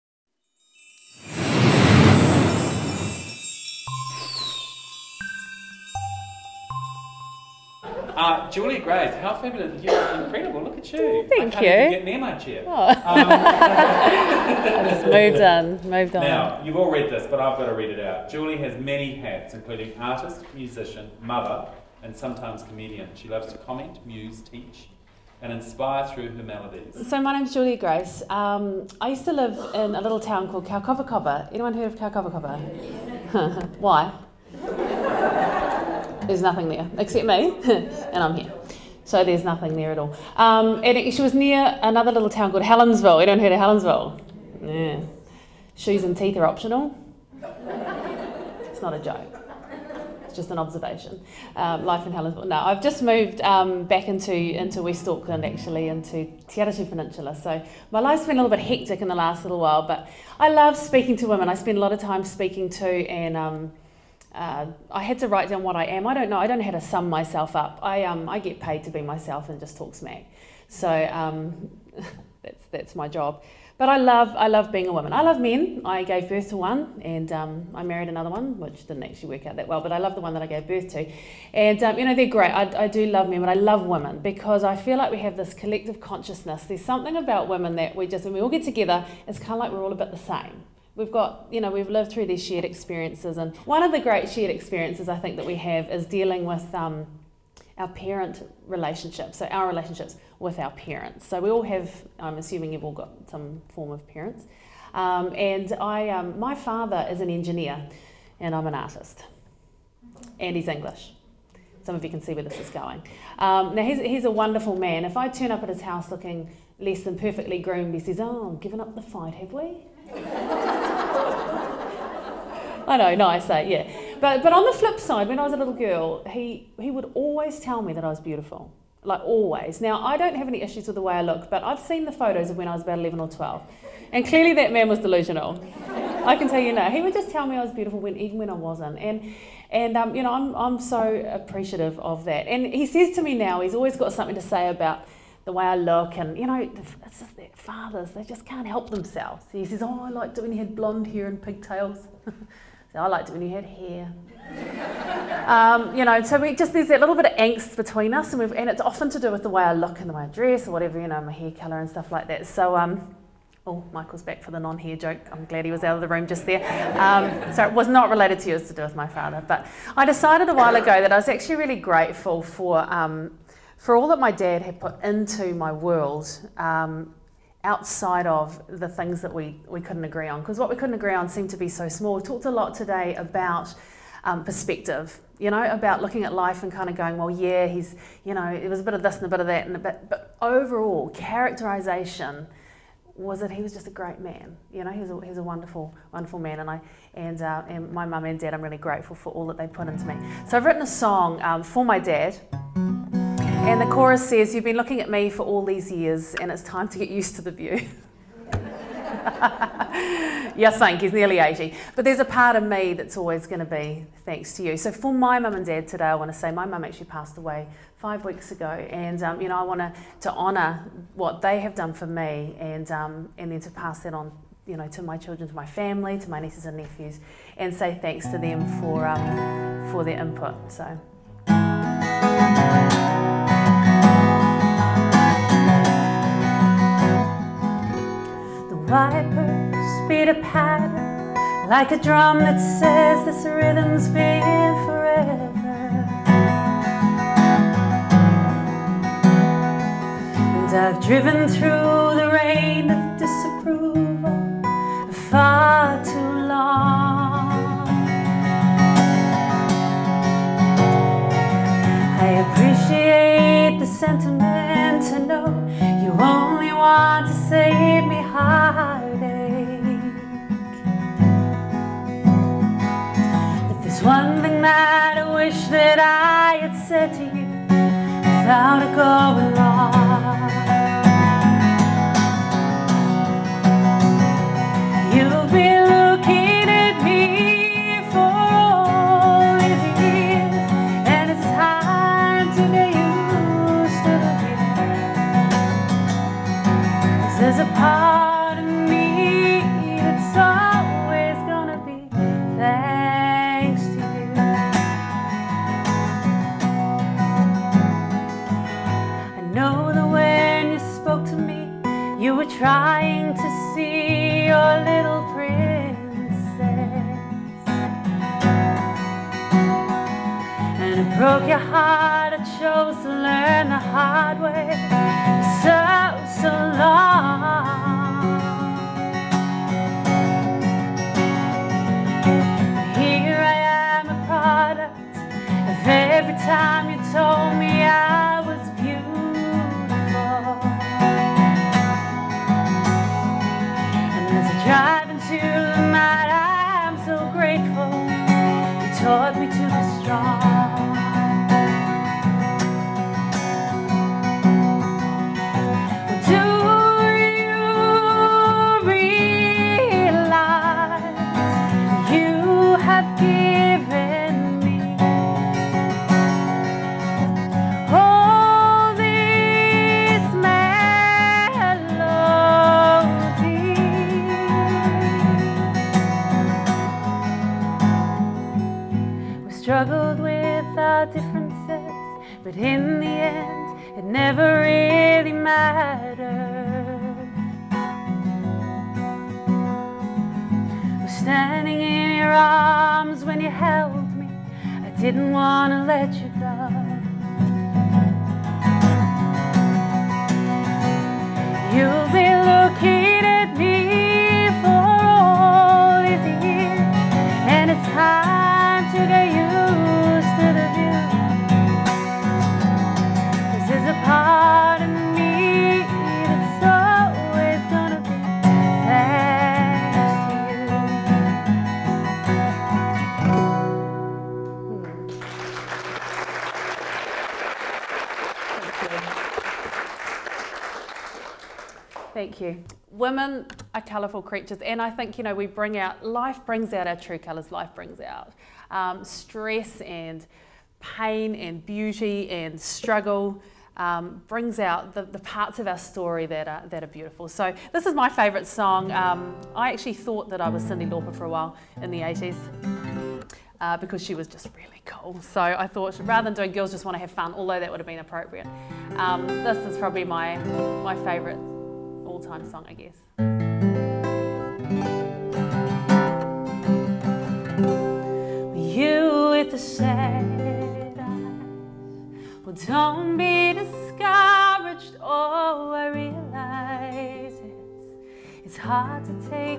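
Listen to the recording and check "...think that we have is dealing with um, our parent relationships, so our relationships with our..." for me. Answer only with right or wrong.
right.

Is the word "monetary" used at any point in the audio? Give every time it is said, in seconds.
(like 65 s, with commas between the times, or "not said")
not said.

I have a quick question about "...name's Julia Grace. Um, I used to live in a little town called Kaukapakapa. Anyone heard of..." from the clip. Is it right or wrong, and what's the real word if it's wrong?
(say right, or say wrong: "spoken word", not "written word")
right.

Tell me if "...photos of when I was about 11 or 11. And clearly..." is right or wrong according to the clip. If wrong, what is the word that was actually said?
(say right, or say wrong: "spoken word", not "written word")
wrong: "12", not "11".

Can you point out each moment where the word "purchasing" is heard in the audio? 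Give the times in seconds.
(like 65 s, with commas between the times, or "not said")
not said.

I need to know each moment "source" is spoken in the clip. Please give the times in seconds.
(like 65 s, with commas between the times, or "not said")
not said.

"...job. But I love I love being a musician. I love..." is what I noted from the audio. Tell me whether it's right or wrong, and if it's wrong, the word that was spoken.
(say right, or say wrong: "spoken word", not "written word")
wrong: "woman", not "musician".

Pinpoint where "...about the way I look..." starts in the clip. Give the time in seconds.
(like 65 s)
144 s.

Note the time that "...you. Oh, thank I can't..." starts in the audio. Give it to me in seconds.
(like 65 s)
10 s.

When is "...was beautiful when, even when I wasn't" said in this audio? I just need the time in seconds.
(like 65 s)
137 s.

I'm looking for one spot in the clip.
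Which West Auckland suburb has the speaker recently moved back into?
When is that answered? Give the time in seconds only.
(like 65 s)
56 s.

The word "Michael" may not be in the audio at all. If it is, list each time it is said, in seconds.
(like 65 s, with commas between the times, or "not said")
163 s.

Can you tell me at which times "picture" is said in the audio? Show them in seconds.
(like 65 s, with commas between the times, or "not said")
not said.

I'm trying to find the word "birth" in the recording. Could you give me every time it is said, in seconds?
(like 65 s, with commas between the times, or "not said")
76 s, 80 s.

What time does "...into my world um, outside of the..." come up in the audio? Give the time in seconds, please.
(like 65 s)
175 s.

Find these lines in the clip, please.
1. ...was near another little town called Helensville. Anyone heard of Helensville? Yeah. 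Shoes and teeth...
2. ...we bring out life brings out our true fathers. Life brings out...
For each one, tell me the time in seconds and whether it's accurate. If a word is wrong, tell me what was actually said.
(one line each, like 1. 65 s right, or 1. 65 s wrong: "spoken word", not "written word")
1. 41 s right
2. 435 s wrong: "colours", not "fathers".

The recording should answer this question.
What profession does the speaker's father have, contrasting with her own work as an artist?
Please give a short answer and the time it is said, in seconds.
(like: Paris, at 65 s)
Engineer, at 107 s.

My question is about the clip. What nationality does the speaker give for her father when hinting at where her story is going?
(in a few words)
English.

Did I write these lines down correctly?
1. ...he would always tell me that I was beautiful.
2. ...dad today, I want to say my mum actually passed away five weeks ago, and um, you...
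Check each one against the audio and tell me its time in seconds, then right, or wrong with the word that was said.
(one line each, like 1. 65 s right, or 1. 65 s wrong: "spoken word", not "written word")
1. 126 s right
2. 215 s right.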